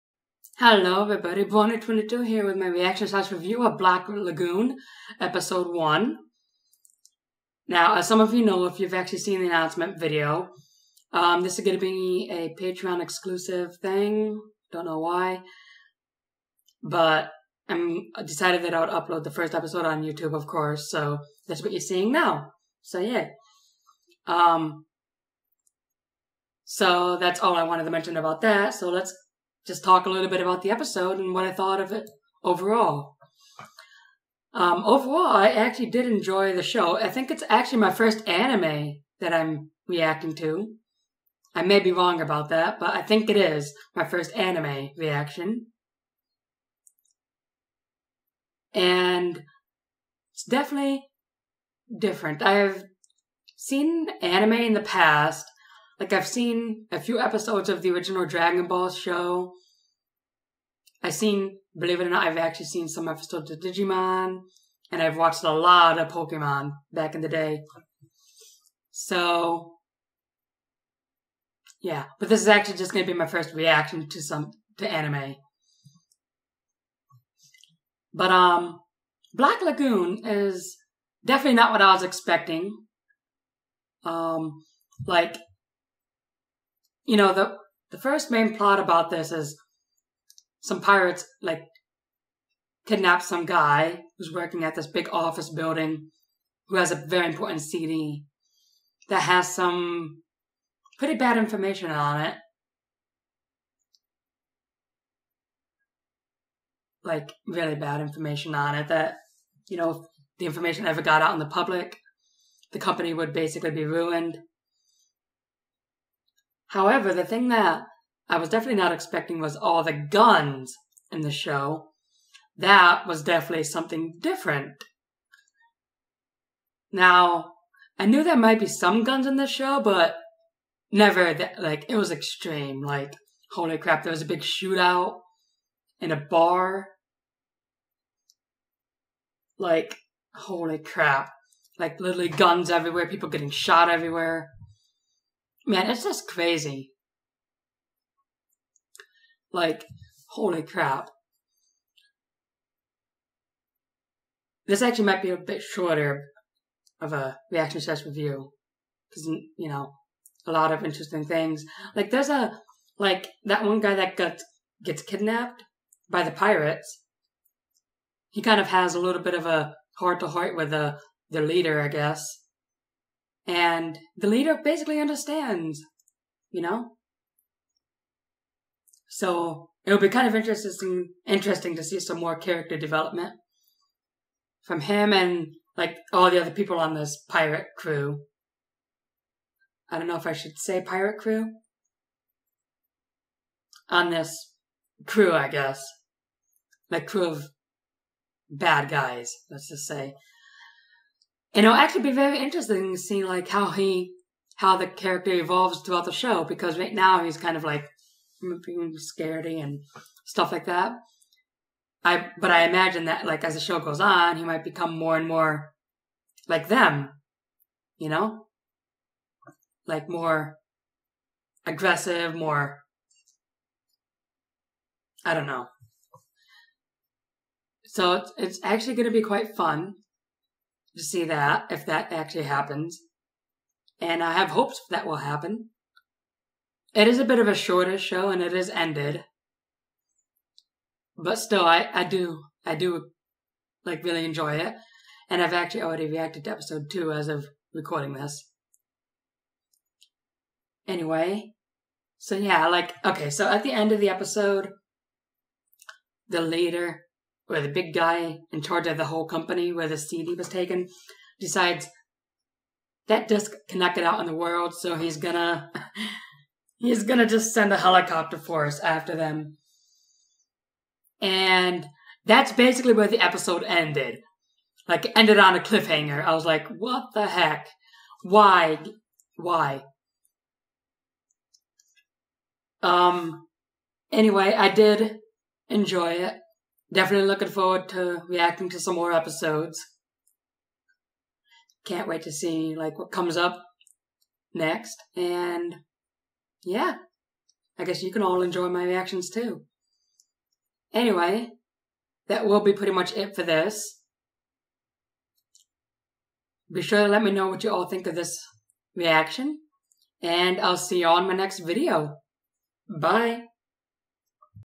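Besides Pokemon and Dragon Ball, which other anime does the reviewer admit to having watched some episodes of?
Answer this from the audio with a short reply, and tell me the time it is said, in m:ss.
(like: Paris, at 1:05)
Digimon, at 1:03.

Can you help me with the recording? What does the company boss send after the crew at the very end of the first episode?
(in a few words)
A helicopter force.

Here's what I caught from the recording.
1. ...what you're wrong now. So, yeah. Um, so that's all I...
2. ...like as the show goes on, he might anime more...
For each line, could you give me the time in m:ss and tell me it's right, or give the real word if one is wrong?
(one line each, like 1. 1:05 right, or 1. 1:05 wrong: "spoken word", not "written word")
1. 0:21 wrong: "seeing", not "wrong"
2. 3:33 wrong: "become", not "anime".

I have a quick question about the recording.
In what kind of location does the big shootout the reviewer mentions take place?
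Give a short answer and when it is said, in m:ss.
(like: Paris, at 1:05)
A bar, at 2:16.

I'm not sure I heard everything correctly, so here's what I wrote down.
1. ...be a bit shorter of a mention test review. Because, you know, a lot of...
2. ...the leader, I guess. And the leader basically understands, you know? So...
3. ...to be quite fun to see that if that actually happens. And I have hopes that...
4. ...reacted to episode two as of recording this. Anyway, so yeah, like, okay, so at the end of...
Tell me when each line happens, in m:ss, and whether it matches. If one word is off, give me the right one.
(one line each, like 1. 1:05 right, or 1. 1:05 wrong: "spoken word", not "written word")
1. 2:35 wrong: "reaction", not "mention"
2. 2:51 right
3. 3:49 right
4. 4:06 right.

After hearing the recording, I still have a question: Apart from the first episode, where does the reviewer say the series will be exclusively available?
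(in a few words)
Patreon.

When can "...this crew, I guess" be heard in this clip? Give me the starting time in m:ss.
3:14.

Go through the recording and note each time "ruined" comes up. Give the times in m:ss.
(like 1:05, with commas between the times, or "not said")
1:53.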